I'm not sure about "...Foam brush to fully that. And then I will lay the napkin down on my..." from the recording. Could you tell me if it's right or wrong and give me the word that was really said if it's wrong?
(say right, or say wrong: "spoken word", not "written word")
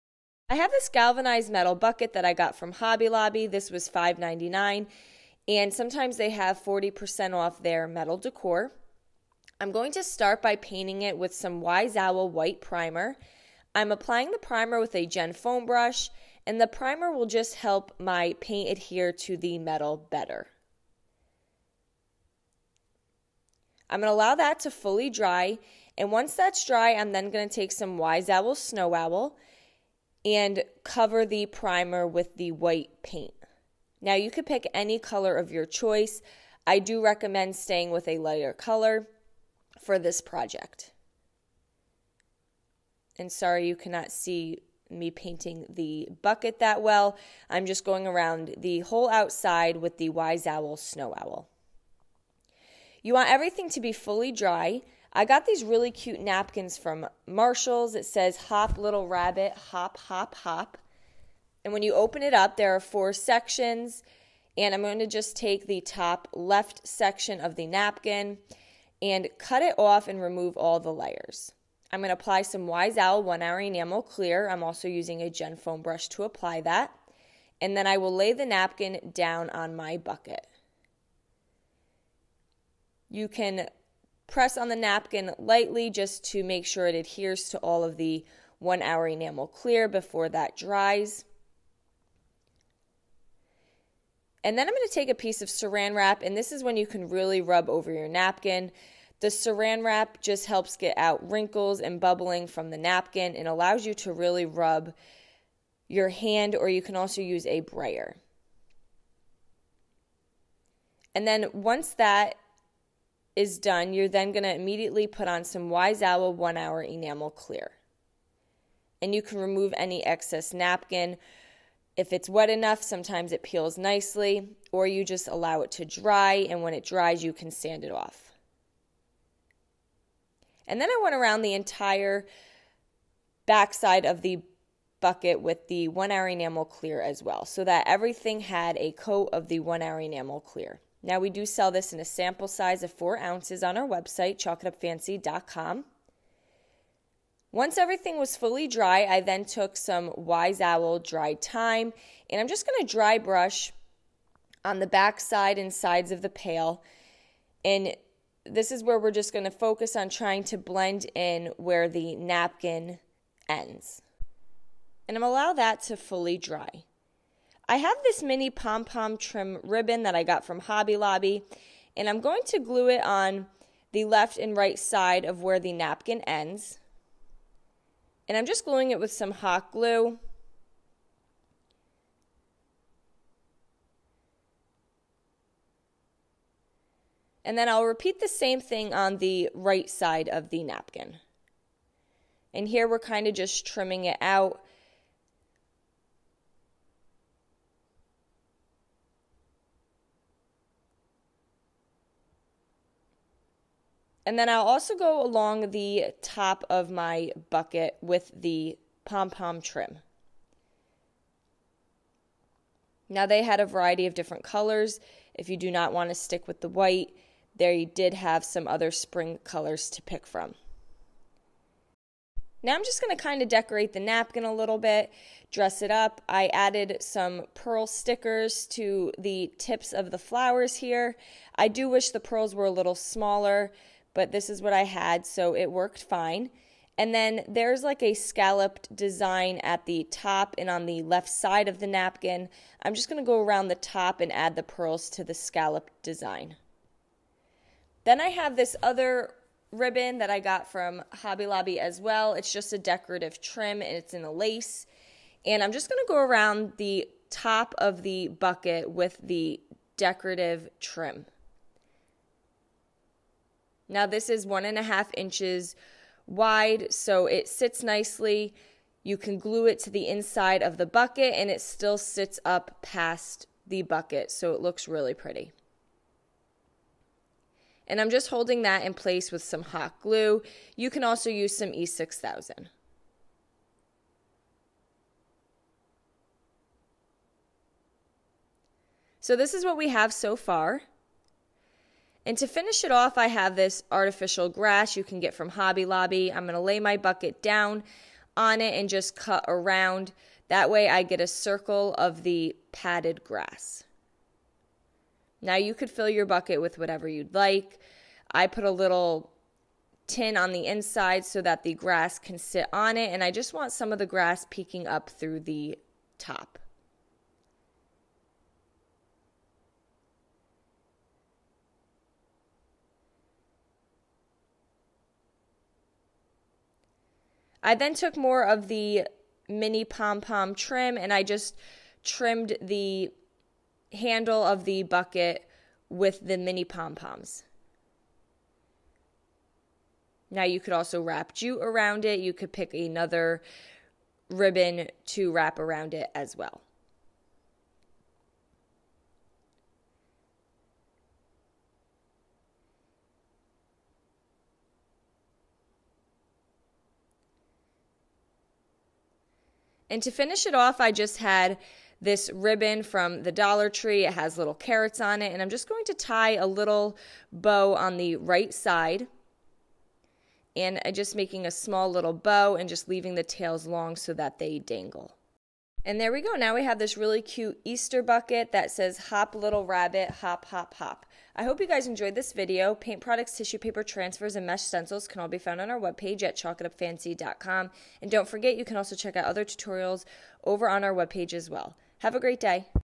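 wrong: "apply", not "fully".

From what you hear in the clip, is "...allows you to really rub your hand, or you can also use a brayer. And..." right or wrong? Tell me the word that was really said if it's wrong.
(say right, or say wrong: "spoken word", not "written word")
right.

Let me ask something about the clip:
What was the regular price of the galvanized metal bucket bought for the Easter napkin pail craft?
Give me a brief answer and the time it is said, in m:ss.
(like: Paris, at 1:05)
$5.99, at 0:03.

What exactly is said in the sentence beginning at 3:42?
Now I'm just going to kind of decorate the napkin a little bit, dress it up.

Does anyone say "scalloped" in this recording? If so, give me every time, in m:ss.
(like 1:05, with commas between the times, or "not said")
3:58, 4:05.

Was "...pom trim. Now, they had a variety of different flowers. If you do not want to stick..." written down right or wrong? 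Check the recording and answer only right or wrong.
wrong.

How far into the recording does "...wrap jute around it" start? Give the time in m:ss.
5:41.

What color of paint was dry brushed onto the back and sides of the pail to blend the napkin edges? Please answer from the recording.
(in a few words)
Dried thyme.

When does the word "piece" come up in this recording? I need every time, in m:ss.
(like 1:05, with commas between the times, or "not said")
1:35.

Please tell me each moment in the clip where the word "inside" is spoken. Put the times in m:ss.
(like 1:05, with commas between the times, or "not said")
4:30, 5:10.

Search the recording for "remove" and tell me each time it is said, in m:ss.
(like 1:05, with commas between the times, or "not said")
1:10, 1:59.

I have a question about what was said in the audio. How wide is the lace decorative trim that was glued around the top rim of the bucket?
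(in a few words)
1.5 inches.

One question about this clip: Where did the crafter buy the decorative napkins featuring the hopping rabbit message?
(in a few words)
Marshalls.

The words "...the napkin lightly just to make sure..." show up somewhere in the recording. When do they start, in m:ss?
1:24.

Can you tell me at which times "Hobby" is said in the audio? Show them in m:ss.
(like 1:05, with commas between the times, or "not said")
0:02, 2:50, 4:11, 4:55.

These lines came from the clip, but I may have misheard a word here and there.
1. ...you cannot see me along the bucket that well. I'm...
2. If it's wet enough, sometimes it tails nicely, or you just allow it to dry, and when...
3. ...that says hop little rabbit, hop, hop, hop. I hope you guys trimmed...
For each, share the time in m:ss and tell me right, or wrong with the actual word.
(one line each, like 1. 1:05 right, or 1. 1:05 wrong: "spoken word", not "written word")
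1. 0:43 wrong: "painting", not "along"
2. 2:01 wrong: "peels", not "tails"
3. 6:18 wrong: "enjoyed", not "trimmed".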